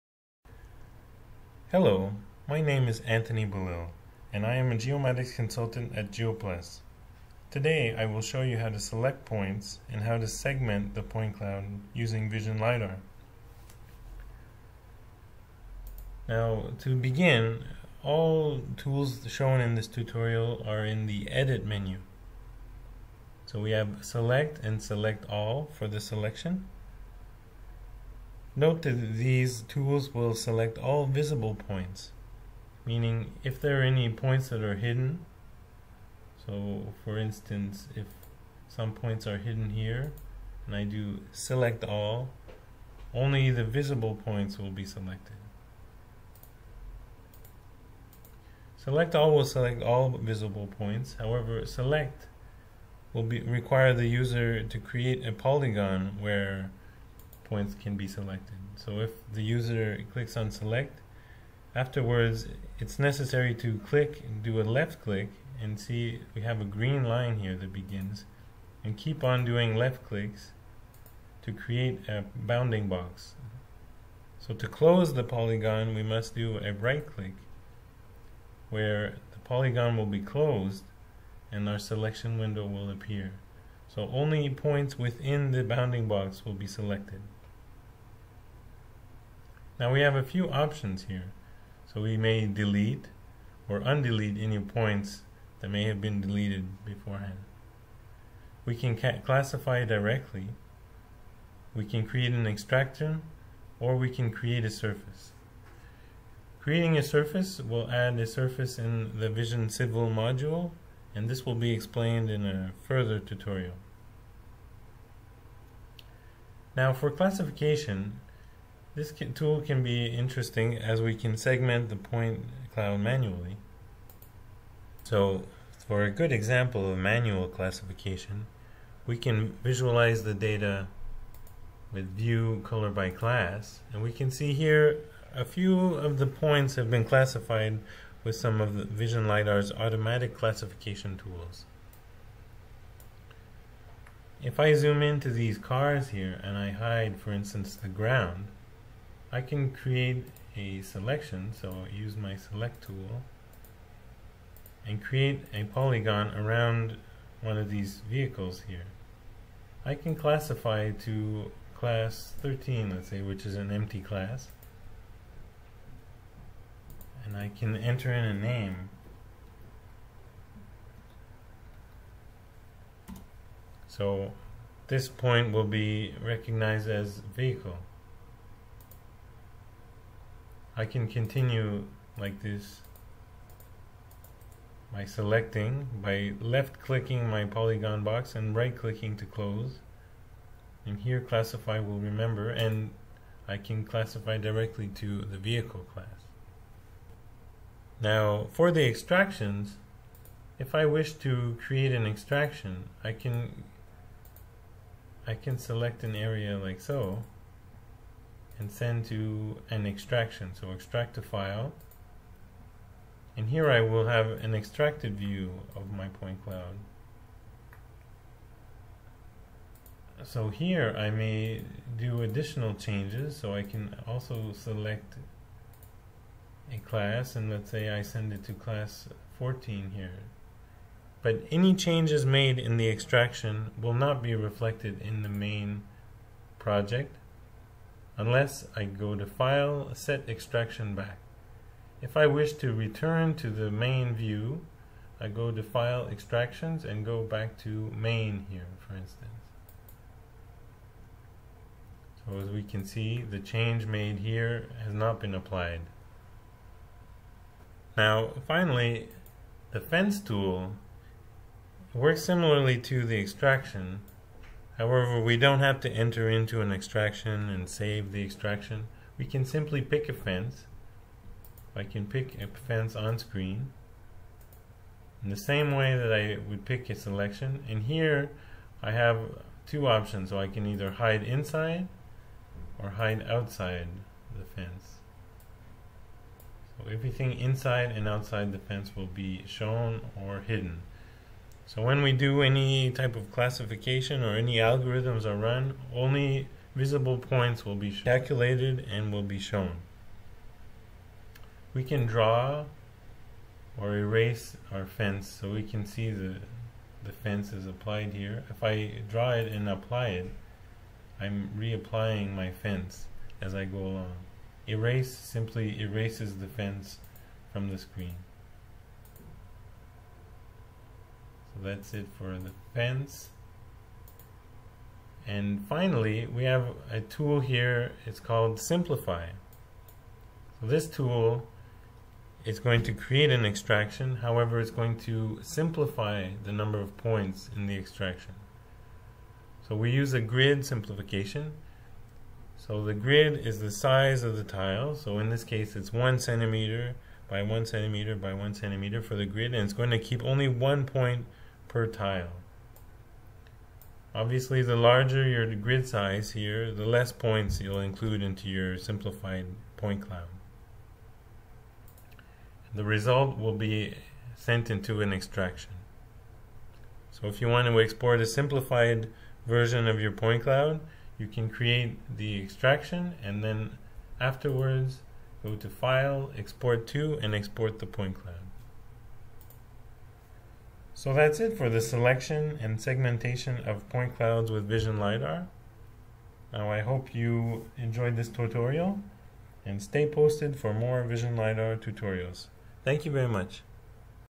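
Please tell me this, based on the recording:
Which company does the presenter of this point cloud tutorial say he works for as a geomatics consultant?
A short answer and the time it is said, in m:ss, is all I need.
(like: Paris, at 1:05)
GeoPlus, at 0:06.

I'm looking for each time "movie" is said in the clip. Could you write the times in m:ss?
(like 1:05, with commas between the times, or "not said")
not said.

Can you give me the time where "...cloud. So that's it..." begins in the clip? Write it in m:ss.
6:18.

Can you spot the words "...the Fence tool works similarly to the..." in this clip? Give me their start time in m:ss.
4:19.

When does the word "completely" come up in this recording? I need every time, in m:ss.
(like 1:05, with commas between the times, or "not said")
not said.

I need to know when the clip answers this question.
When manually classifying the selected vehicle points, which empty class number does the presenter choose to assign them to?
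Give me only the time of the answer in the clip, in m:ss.
2:41.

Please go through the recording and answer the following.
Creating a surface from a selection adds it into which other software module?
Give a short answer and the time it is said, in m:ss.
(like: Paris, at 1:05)
Vision Civil, at 1:49.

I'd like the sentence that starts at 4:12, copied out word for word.
So as we can see, the change made here has not been applied.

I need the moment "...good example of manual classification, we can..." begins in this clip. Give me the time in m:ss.
2:06.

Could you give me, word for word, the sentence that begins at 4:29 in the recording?
We can simply pick a fence.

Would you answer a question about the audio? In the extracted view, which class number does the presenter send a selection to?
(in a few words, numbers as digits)
14.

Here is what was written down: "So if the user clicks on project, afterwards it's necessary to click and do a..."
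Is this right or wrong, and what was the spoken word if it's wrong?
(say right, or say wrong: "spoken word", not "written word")
wrong: "select", not "project".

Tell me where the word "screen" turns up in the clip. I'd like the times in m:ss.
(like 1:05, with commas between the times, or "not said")
4:33, 5:17.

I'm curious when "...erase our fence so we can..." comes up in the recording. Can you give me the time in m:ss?
5:03.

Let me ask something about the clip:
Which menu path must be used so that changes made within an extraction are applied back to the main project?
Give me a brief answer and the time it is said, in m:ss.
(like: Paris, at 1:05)
File, Set Extraction Back, at 3:59.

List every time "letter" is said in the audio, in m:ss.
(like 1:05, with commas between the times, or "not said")
not said.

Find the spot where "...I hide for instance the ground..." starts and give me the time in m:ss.
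2:26.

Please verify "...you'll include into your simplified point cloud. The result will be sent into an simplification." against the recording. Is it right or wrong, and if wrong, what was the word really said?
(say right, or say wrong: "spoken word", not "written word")
wrong: "extraction", not "simplification".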